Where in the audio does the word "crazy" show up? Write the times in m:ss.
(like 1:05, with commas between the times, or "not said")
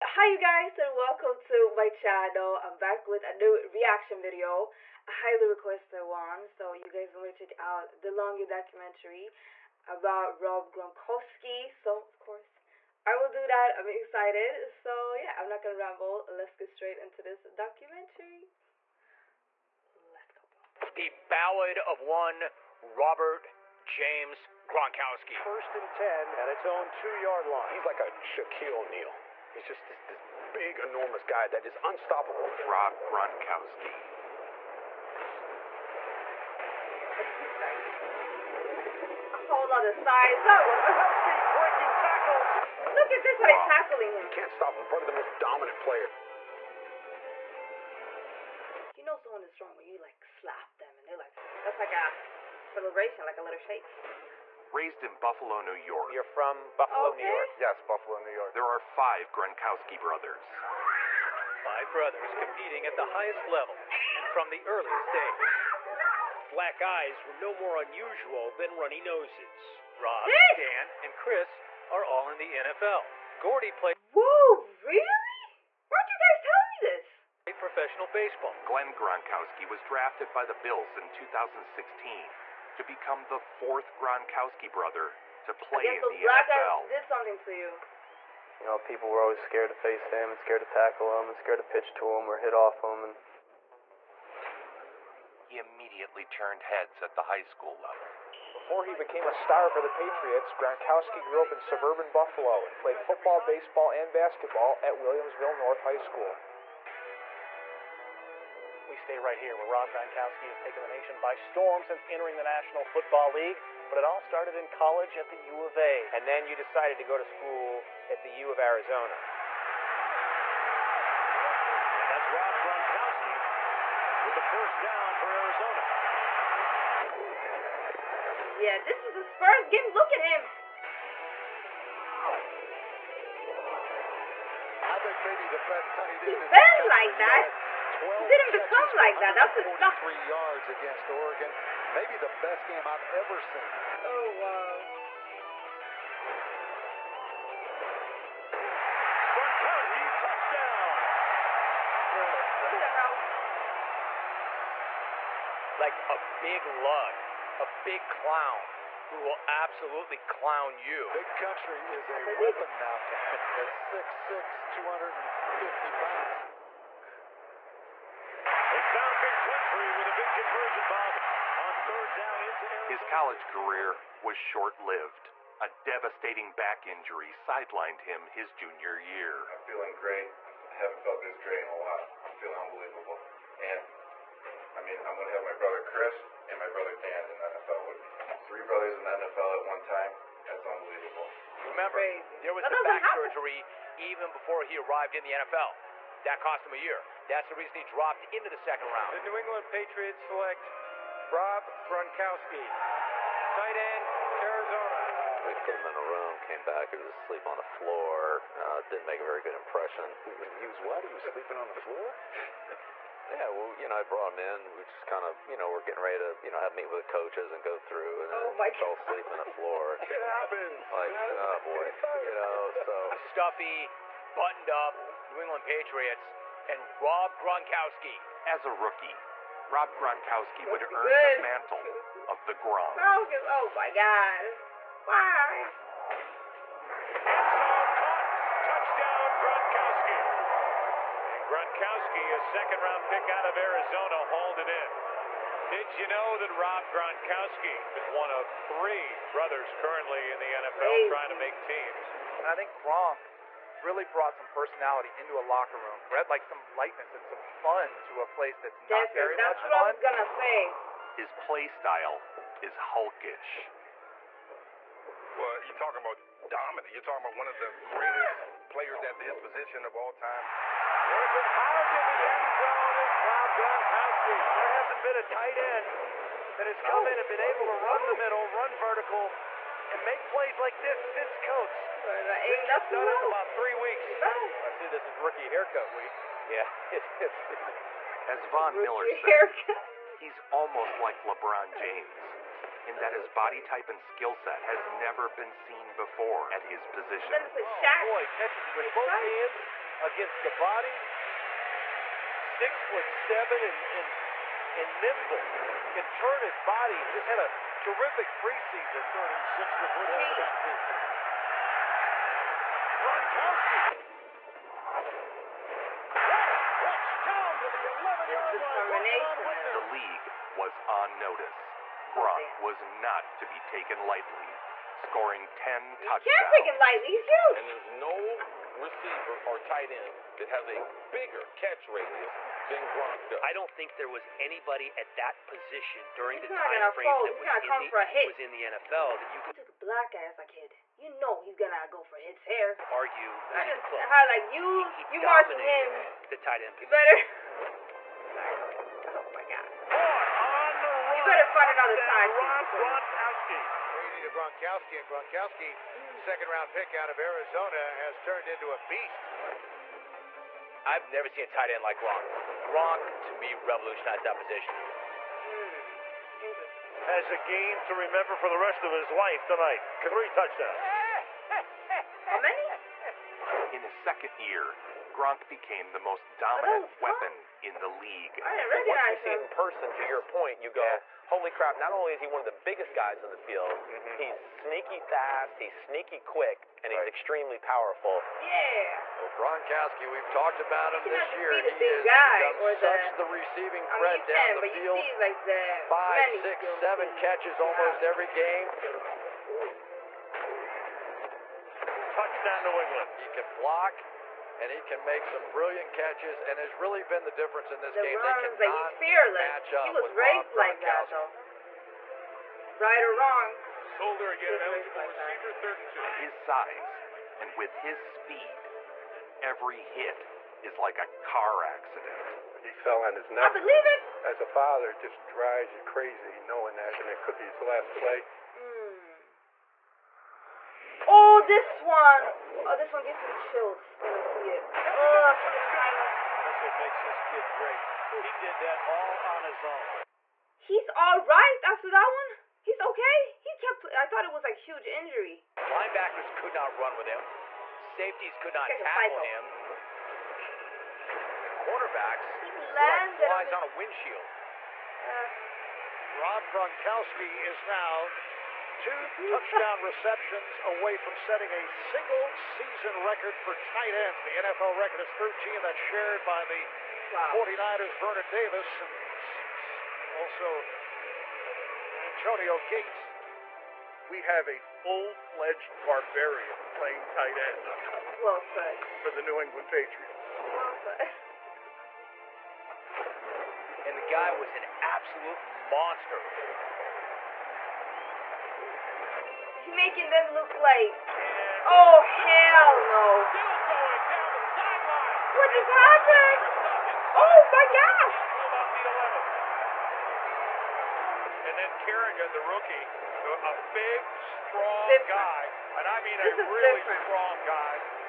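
4:10, 7:05.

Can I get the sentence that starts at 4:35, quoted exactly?
There hasn't been a tight end that has come oh.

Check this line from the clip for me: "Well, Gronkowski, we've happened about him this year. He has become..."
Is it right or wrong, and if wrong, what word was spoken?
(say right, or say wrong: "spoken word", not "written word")
wrong: "talked", not "happened".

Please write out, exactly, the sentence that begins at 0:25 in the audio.
First and 10 at its own two yard line.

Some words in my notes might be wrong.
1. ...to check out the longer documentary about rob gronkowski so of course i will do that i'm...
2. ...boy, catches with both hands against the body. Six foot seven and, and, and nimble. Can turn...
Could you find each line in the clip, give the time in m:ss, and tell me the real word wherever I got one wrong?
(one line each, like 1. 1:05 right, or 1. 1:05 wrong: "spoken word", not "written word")
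1. 0:07 right
2. 4:58 right.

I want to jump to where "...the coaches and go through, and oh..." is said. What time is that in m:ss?
3:37.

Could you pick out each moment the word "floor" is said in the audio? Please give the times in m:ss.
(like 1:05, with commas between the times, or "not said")
3:27, 3:31, 3:39.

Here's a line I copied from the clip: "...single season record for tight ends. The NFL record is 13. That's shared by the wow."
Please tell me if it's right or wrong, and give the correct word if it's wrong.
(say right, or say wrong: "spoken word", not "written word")
right.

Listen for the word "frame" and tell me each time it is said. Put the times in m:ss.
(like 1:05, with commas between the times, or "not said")
5:36.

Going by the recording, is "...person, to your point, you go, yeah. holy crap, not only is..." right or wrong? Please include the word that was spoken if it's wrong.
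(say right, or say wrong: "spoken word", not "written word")
right.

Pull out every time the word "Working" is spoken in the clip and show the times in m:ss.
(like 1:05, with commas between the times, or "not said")
4:30.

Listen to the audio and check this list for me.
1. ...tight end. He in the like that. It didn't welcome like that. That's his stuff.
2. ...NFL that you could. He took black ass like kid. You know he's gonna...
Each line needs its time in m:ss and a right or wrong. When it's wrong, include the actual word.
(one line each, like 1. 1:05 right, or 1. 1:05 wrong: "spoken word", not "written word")
1. 2:15 wrong: "become", not "welcome"
2. 5:38 right.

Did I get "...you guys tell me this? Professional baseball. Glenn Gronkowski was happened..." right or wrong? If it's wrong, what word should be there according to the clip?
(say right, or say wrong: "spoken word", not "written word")
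wrong: "drafted", not "happened".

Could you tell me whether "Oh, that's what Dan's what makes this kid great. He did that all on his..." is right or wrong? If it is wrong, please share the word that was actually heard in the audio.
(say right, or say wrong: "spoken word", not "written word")
wrong: "That", not "Dan".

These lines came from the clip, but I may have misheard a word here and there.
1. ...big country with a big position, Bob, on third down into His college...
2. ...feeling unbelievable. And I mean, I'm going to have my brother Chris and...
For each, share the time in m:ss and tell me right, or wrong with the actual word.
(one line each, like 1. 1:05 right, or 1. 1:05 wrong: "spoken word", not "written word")
1. 2:49 wrong: "conversion", not "position"
2. 3:02 right.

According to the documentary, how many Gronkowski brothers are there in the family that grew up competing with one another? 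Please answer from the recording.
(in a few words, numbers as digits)
5.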